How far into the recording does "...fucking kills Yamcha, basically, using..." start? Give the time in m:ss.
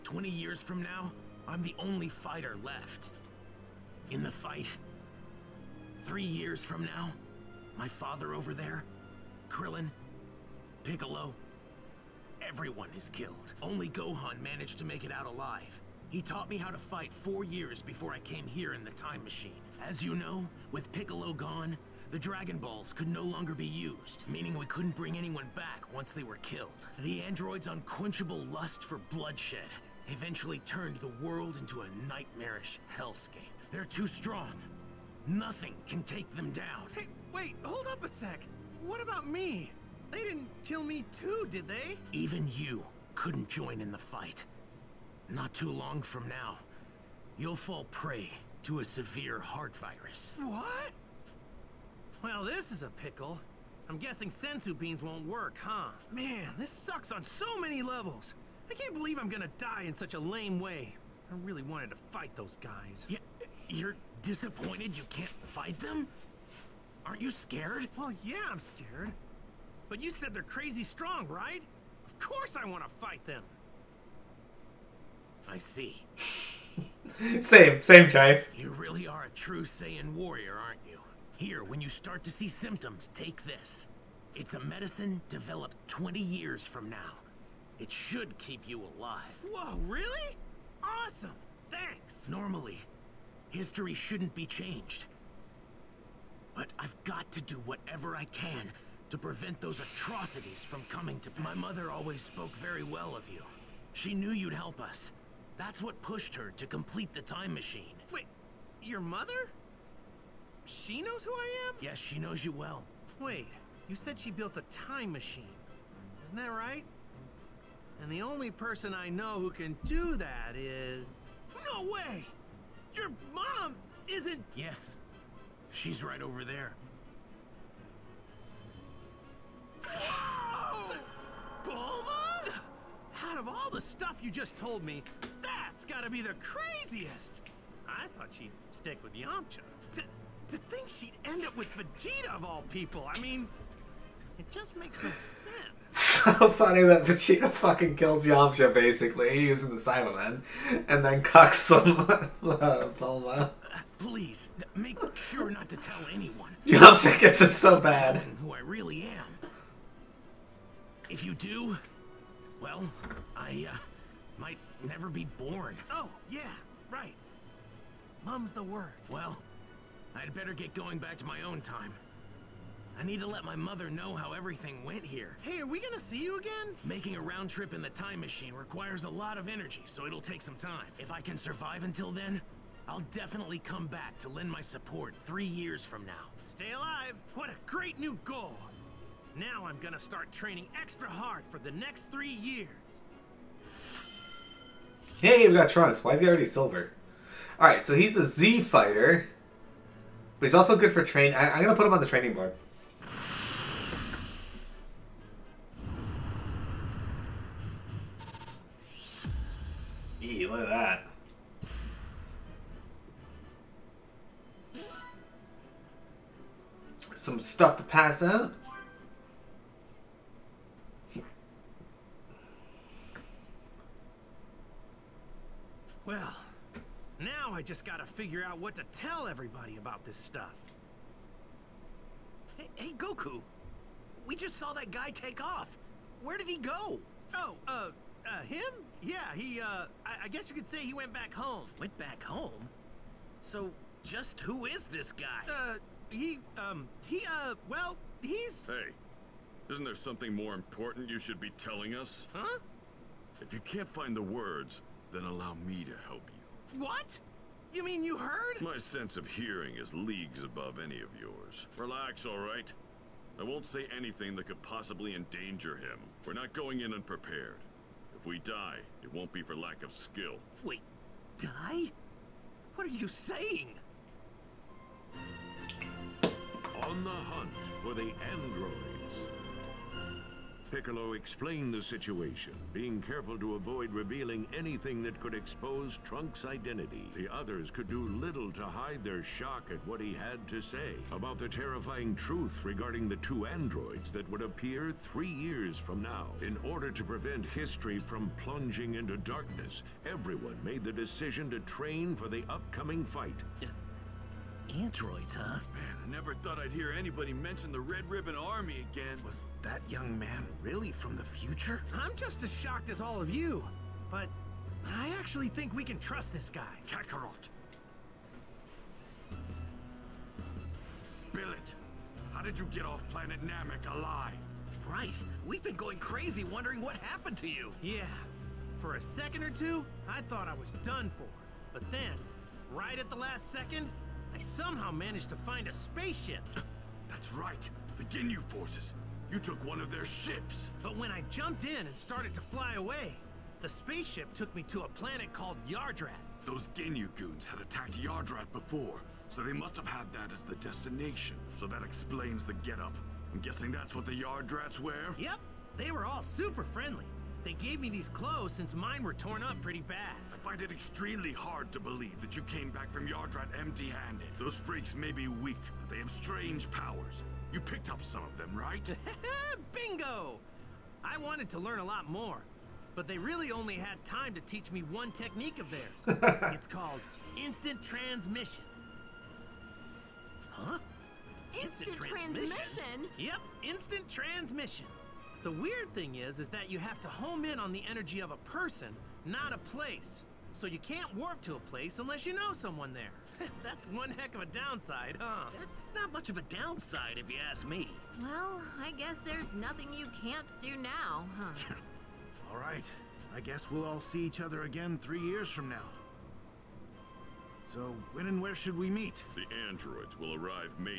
2:27.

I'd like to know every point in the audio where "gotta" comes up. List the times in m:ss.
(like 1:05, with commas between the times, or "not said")
2:15, 3:47.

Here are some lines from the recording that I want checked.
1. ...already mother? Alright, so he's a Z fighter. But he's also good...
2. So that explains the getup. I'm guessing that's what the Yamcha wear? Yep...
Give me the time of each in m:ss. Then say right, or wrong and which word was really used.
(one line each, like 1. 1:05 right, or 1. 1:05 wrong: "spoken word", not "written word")
1. 3:16 wrong: "silver", not "mother"
2. 5:51 wrong: "Yardrats", not "Yamcha".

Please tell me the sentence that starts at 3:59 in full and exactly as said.
Yeah, he, uh, I, I guess you could say he went back home.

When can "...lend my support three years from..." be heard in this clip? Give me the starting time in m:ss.
3:04.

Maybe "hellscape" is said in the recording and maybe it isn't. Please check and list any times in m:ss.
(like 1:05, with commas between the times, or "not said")
0:32.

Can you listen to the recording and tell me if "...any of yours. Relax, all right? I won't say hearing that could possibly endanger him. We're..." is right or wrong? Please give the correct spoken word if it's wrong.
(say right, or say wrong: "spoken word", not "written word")
wrong: "anything", not "hearing".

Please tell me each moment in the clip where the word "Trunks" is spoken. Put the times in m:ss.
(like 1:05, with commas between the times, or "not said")
3:15, 4:46.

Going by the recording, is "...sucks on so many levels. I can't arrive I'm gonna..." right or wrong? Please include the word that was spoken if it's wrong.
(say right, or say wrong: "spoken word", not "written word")
wrong: "believe", not "arrive".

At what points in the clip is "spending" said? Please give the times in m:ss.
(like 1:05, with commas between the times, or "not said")
not said.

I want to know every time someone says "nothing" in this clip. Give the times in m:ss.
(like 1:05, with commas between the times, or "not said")
0:35, 6:39.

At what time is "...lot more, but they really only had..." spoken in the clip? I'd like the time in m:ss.
6:11.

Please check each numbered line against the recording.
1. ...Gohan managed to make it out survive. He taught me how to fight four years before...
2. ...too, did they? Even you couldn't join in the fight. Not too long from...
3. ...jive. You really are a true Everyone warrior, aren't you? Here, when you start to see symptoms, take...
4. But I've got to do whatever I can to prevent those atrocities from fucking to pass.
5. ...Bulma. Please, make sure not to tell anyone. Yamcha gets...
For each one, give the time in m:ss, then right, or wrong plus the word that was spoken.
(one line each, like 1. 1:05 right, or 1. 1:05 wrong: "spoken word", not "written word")
1. 0:13 wrong: "alive", not "survive"
2. 0:41 right
3. 1:18 wrong: "Saiyan", not "Everyone"
4. 1:36 wrong: "coming", not "fucking"
5. 2:32 right.